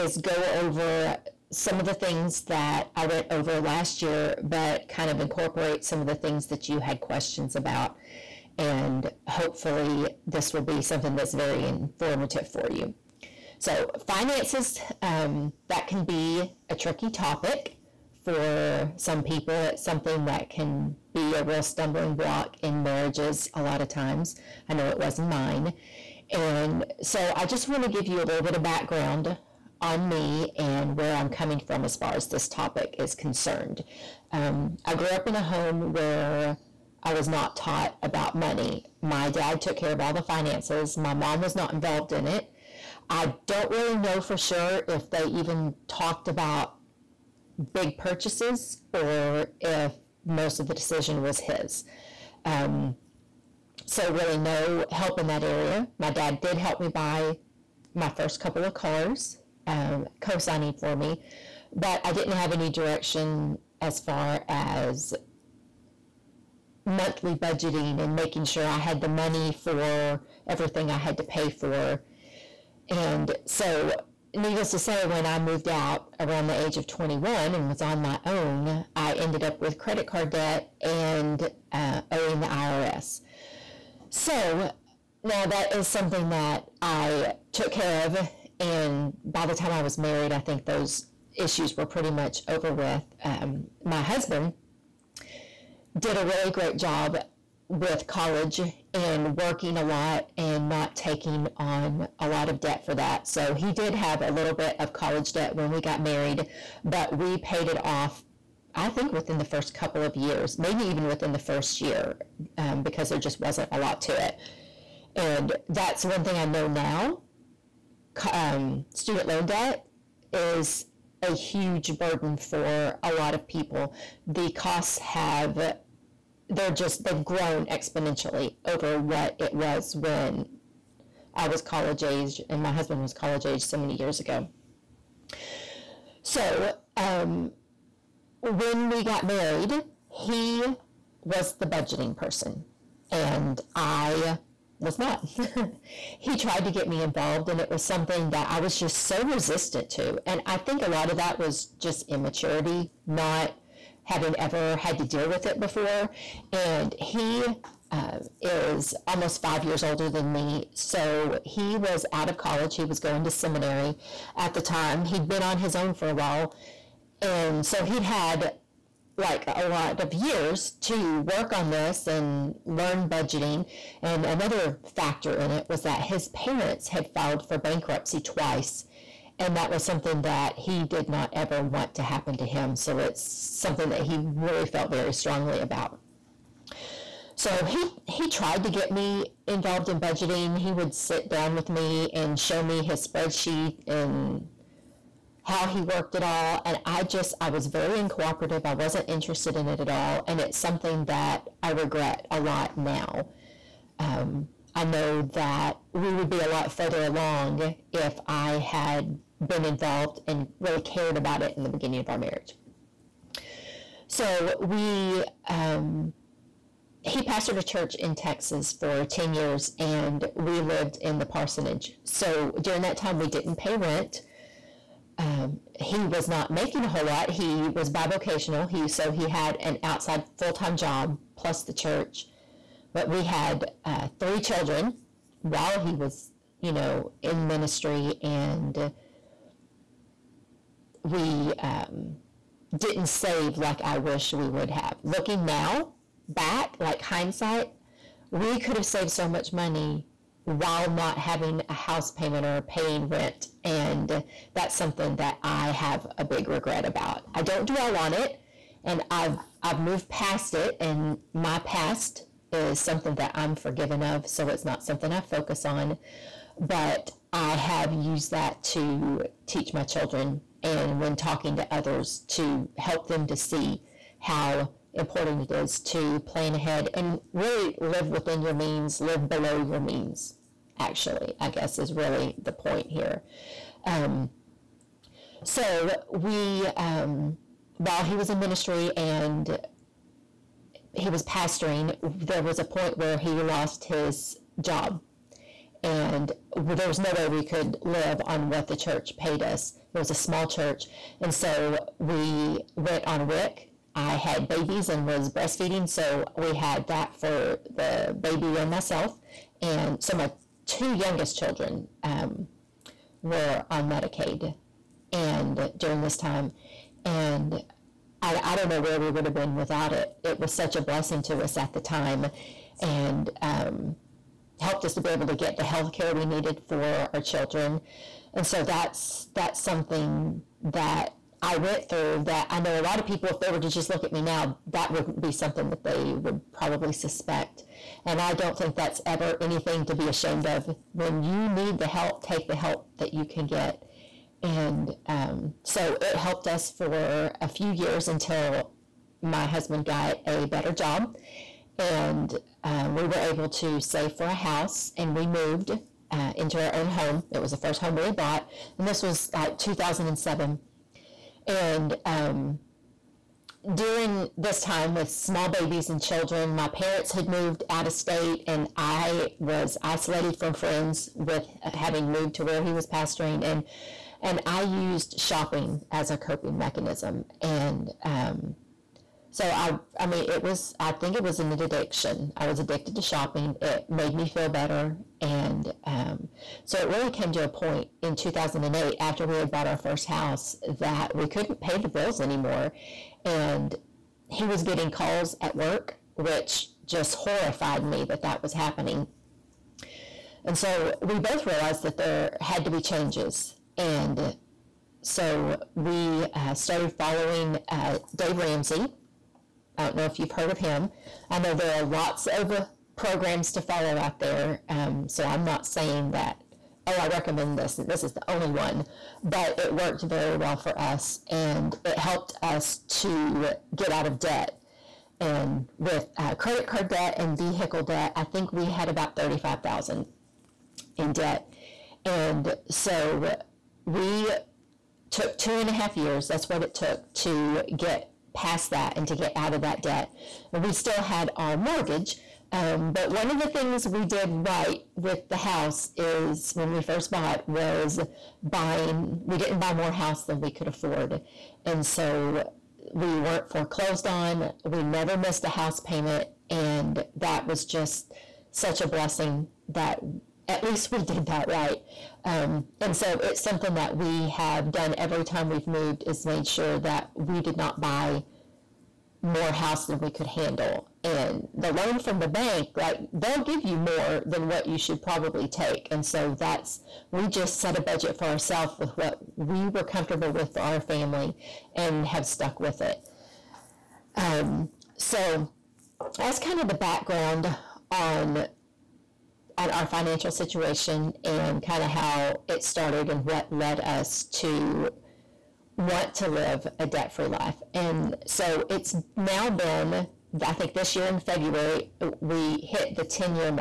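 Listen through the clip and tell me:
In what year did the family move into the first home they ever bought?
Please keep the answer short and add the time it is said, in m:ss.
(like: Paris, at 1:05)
2007, at 5:59.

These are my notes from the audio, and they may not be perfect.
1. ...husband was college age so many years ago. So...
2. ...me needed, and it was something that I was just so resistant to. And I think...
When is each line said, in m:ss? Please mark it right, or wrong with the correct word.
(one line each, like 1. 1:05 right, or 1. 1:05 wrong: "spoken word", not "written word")
1. 2:12 right
2. 2:26 wrong: "involved", not "needed".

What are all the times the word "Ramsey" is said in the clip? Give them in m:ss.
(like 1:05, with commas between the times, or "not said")
6:48.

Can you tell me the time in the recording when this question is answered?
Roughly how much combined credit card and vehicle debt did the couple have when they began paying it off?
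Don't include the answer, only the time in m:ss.
7:09.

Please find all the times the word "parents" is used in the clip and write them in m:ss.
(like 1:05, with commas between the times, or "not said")
2:56, 6:06.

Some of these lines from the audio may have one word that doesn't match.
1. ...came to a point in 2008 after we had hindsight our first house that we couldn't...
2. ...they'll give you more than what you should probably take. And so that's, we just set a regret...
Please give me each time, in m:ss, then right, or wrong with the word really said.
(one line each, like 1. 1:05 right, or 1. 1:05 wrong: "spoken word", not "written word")
1. 6:27 wrong: "bought", not "hindsight"
2. 7:53 wrong: "budget", not "regret".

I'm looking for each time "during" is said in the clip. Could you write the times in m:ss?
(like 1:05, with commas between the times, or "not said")
3:42, 5:15, 6:03.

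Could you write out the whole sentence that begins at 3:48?
He so he had an outside full time job plus the church.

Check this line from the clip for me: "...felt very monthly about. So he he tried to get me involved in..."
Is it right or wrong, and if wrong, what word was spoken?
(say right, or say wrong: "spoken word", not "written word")
wrong: "strongly", not "monthly".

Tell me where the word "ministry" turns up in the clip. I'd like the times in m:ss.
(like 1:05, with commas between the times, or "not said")
3:57, 4:48.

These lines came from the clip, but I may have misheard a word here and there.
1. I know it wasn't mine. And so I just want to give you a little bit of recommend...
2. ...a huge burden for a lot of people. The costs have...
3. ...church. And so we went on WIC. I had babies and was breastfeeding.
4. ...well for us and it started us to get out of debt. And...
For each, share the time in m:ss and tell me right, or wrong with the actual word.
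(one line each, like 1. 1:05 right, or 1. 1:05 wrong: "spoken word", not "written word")
1. 0:24 wrong: "background", not "recommend"
2. 2:01 right
3. 5:00 right
4. 7:00 wrong: "helped", not "started".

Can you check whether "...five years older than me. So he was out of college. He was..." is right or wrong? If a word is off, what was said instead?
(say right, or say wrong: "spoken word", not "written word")
right.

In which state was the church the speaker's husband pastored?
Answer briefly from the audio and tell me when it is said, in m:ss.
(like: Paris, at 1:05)
Texas, at 3:38.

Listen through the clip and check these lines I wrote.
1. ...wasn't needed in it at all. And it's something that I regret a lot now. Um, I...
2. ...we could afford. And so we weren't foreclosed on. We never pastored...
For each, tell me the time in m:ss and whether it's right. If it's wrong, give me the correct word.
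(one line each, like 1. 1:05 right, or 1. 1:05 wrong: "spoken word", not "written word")
1. 3:18 wrong: "interested", not "needed"
2. 7:30 wrong: "missed", not "pastored".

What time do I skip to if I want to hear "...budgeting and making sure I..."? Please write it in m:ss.
1:07.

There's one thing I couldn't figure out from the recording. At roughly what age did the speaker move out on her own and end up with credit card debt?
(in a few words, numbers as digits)
21.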